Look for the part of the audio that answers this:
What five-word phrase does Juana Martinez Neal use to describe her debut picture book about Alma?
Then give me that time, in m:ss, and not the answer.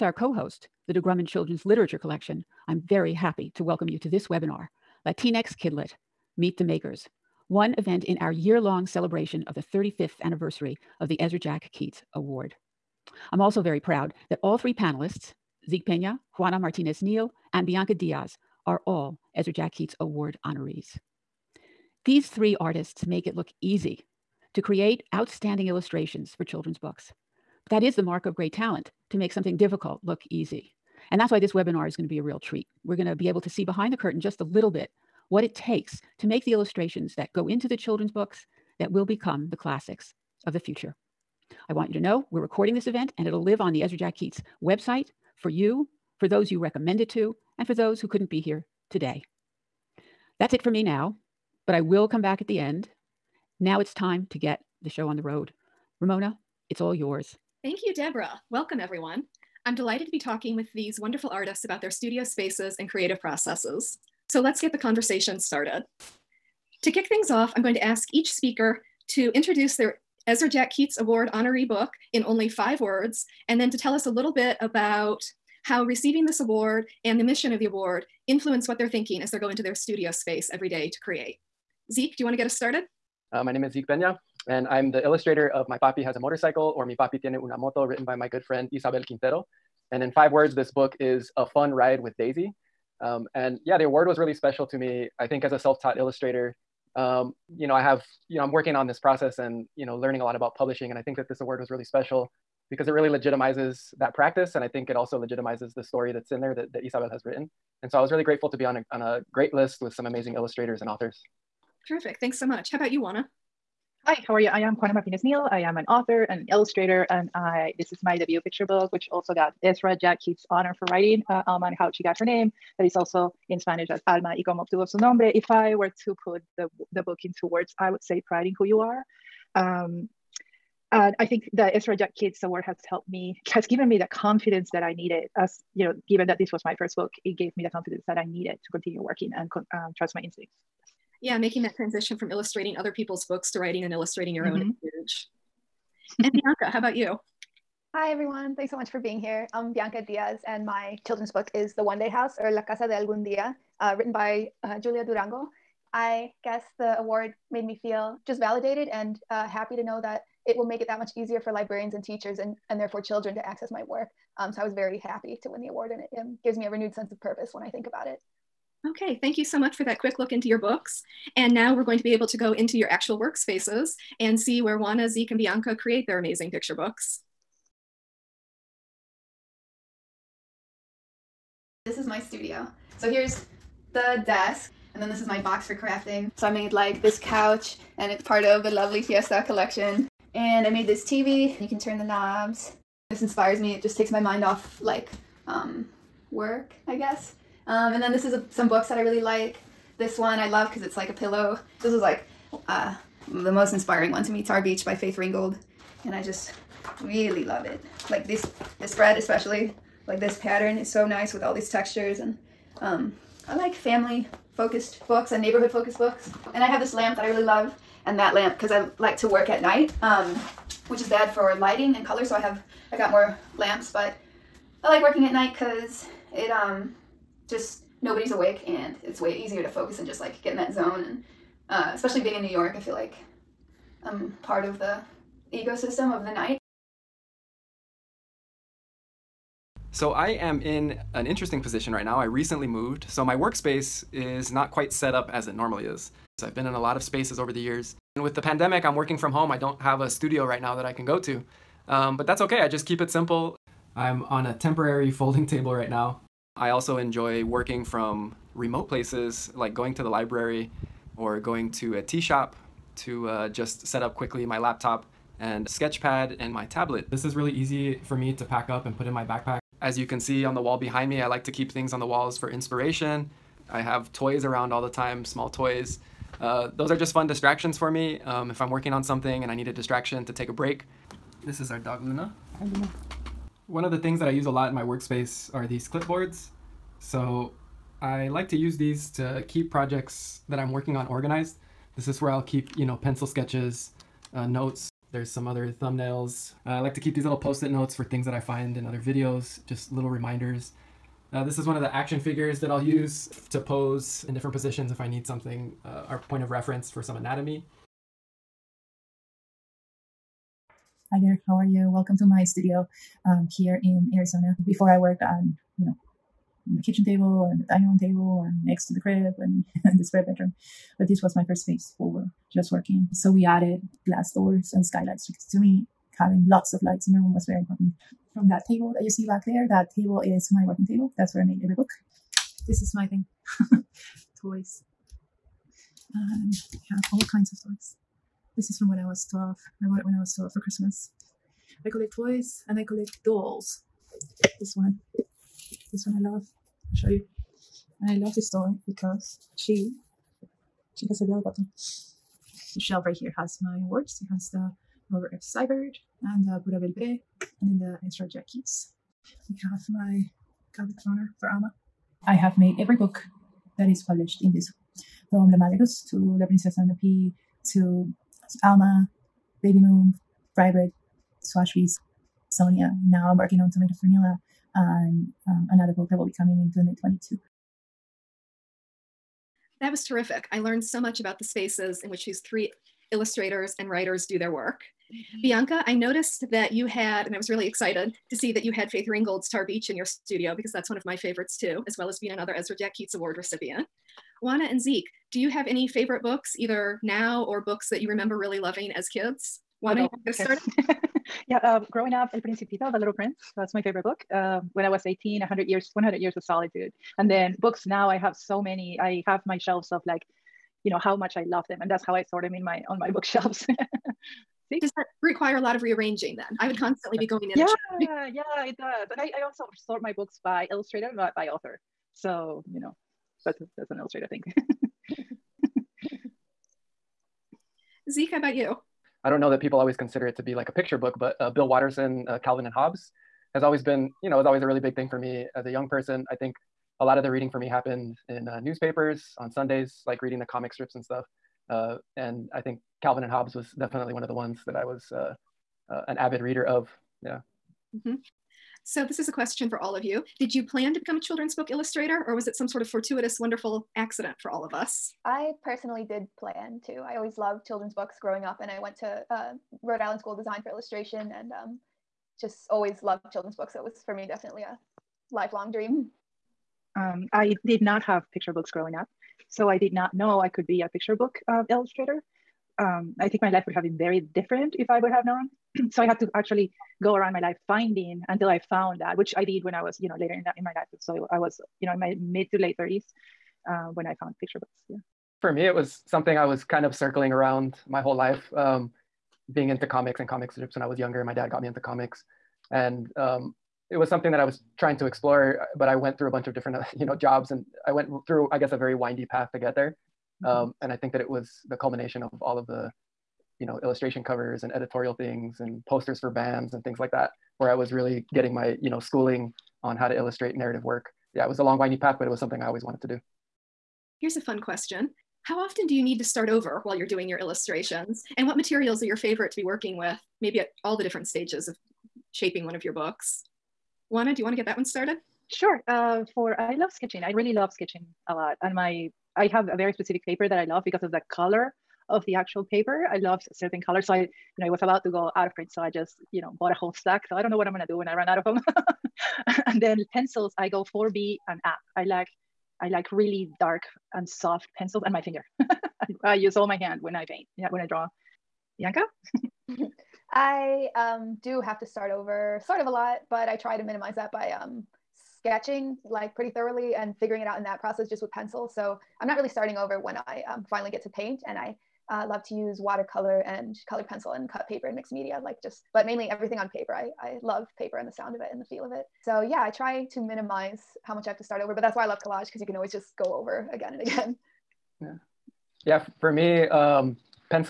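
2:08.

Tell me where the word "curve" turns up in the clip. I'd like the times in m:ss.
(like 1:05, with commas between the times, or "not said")
not said.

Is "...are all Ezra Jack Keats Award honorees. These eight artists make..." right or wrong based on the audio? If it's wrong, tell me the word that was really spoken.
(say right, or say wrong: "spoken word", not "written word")
wrong: "three", not "eight".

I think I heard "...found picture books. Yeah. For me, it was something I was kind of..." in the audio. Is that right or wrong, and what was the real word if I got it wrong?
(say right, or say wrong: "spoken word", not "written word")
right.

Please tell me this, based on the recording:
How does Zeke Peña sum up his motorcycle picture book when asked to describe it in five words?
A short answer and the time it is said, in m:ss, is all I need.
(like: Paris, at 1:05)
A Fun Ride with Daisy, at 1:31.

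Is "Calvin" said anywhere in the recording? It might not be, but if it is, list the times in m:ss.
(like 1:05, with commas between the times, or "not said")
7:12, 7:23.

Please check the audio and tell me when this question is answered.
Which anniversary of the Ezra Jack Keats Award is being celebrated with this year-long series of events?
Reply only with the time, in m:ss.
0:09.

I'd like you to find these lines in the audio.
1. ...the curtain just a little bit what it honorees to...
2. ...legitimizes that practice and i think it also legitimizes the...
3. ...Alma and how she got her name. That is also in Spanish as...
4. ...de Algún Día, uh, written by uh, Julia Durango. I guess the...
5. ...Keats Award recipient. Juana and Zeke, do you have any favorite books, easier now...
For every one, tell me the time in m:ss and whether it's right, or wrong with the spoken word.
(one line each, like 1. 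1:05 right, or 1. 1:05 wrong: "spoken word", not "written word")
1. 0:33 wrong: "takes", not "honorees"
2. 1:43 right
3. 2:01 right
4. 2:32 right
5. 6:32 wrong: "either", not "easier".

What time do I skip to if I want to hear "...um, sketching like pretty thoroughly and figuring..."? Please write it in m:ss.
9:14.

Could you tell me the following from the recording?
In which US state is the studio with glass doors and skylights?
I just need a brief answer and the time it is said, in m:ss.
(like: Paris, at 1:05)
Arizona, at 5:14.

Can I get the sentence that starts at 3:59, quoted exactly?
So I am in an interesting position right now.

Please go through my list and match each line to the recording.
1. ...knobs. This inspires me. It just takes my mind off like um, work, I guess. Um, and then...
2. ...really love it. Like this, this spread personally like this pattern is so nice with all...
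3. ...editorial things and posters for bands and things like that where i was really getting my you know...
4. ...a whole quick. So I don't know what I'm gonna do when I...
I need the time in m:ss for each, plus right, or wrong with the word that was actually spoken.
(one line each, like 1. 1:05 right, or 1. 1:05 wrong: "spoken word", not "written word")
1. 3:12 right
2. 3:27 wrong: "especially", not "personally"
3. 8:24 right
4. 8:56 wrong: "stack", not "quick".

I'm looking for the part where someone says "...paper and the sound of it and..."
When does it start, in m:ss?
9:27.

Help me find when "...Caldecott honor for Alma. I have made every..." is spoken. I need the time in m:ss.
6:00.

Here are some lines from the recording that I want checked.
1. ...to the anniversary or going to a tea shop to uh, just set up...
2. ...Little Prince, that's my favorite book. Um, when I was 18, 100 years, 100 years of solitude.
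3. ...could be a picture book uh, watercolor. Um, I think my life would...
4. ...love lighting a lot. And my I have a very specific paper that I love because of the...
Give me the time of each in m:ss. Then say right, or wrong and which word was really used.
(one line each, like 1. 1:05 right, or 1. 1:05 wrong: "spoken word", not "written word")
1. 4:19 wrong: "library", not "anniversary"
2. 6:42 right
3. 7:50 wrong: "illustrator", not "watercolor"
4. 8:47 wrong: "sketching", not "lighting".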